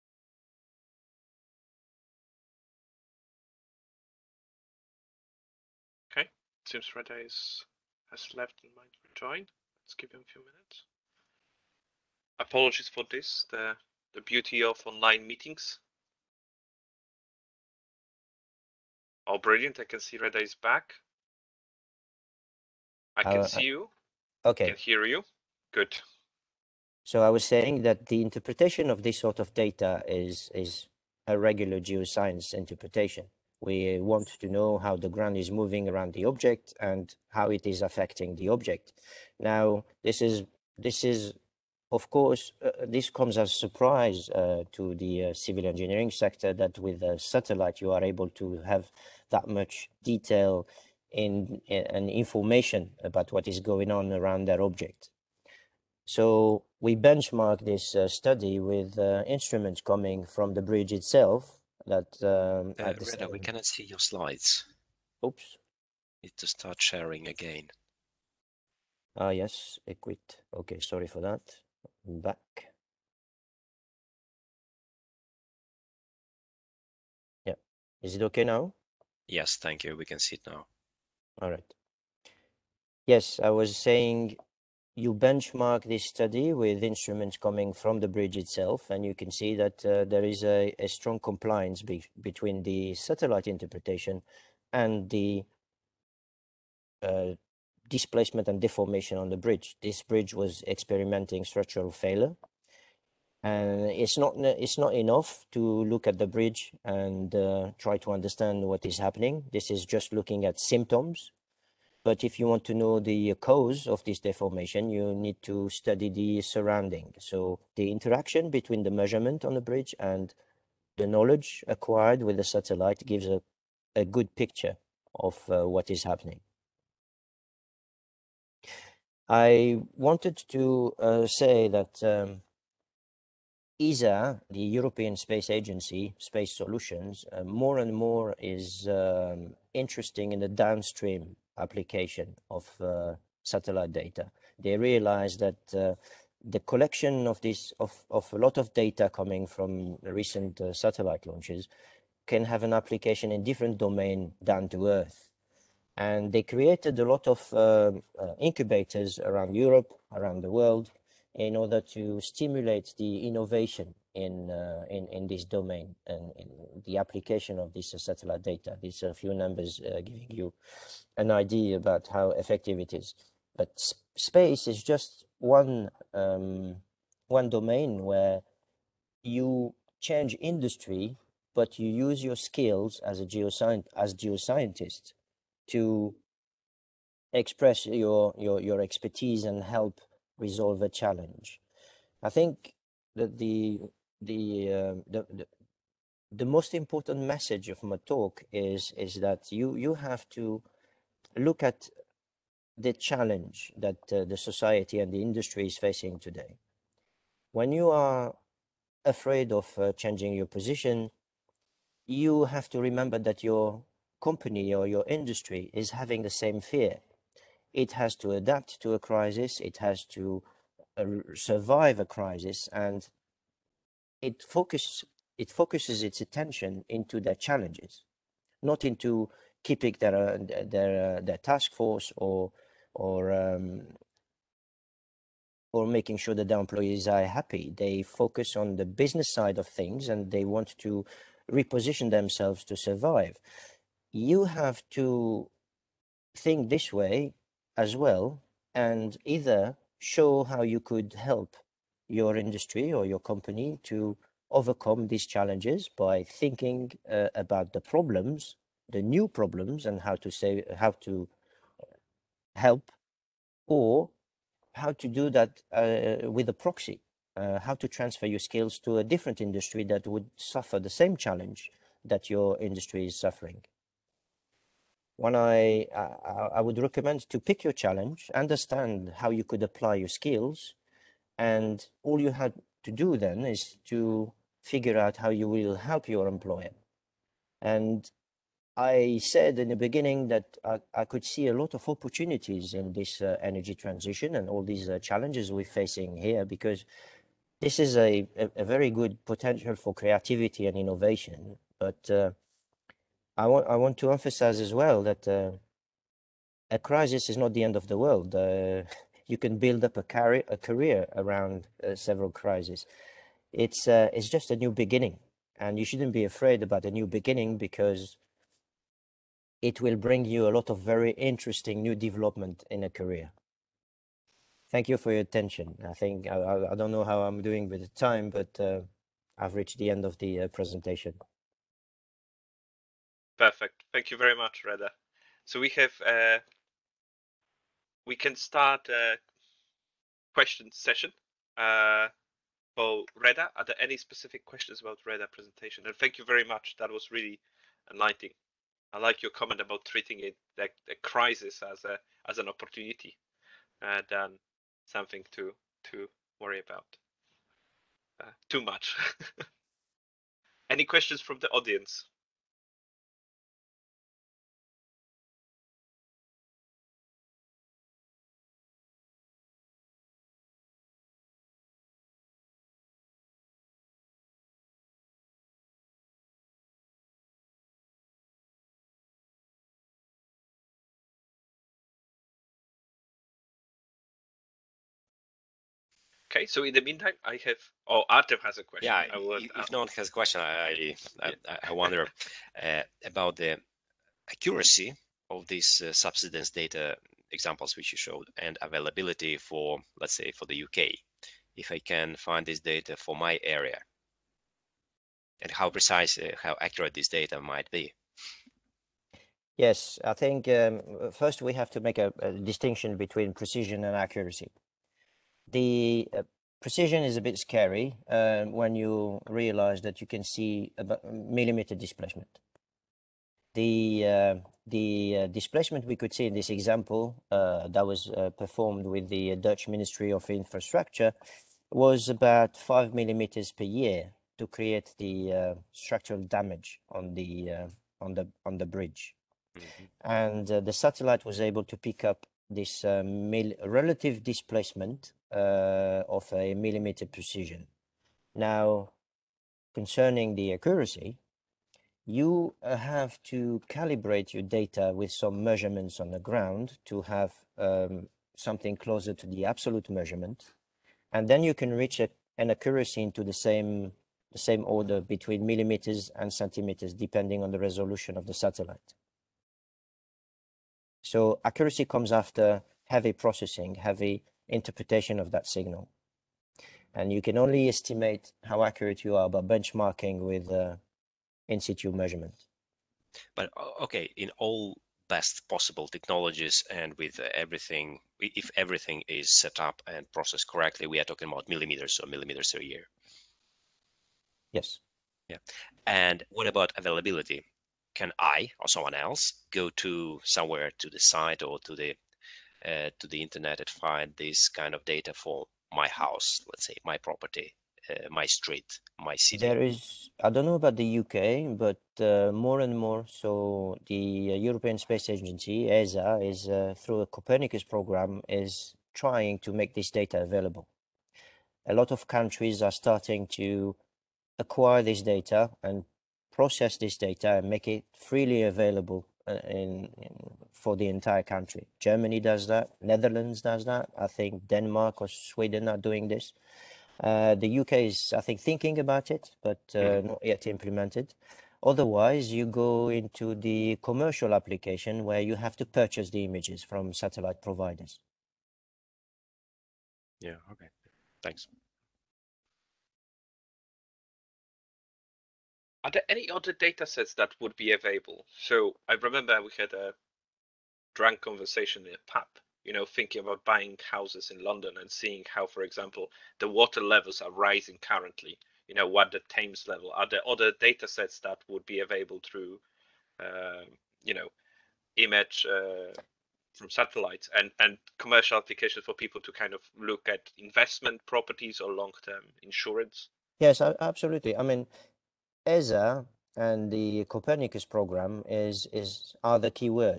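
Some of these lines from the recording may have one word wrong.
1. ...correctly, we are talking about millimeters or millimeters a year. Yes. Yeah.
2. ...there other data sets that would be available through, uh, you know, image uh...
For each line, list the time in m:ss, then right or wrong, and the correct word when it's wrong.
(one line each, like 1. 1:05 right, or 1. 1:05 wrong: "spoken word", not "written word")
1. 8:10 right
2. 9:30 right.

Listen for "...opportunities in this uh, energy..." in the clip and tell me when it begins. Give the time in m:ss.
4:51.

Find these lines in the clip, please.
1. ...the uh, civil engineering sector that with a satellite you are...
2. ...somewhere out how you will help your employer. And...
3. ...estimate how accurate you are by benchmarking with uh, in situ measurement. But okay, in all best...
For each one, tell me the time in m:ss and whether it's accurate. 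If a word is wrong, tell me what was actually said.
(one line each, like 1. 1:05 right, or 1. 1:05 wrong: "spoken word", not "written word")
1. 0:44 right
2. 4:44 wrong: "figure", not "somewhere"
3. 7:57 right.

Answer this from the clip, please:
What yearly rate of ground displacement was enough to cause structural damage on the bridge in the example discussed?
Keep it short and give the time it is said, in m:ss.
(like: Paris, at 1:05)
5 millimeters per year, at 7:12.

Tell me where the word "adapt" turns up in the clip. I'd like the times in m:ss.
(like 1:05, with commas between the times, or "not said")
3:38.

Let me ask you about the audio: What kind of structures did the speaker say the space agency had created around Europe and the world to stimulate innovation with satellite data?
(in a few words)
incubators.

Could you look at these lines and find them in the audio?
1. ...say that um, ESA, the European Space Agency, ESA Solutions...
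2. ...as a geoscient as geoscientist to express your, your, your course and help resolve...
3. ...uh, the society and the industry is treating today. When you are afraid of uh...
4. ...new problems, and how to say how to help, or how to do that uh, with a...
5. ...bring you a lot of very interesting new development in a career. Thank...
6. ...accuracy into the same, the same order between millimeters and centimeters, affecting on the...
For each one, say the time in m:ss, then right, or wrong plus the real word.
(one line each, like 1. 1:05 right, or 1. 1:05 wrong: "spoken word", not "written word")
1. 2:11 wrong: "Space", not "ESA"
2. 3:03 wrong: "expertise", not "course"
3. 3:24 wrong: "facing", not "treating"
4. 4:19 right
5. 5:19 right
6. 7:42 wrong: "depending", not "affecting".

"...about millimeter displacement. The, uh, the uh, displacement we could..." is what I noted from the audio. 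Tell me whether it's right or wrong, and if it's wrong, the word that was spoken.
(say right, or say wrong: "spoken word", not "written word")
right.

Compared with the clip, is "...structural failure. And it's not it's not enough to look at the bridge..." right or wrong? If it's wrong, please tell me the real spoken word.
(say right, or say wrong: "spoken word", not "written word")
right.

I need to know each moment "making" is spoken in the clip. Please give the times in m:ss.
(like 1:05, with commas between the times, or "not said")
3:55.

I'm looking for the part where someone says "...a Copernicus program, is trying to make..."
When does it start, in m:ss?
8:36.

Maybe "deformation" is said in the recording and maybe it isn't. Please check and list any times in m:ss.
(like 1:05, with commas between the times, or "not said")
1:38, 1:54.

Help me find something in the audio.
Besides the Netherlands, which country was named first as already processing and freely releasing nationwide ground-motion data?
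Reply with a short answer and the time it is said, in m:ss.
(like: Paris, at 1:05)
Germany, at 8:51.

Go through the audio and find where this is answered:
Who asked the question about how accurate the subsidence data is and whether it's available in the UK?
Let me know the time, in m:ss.
6:28.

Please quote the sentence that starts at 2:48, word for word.
These are few numbers uh, giving you an idea about how effective it is.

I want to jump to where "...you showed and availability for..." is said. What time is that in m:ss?
6:37.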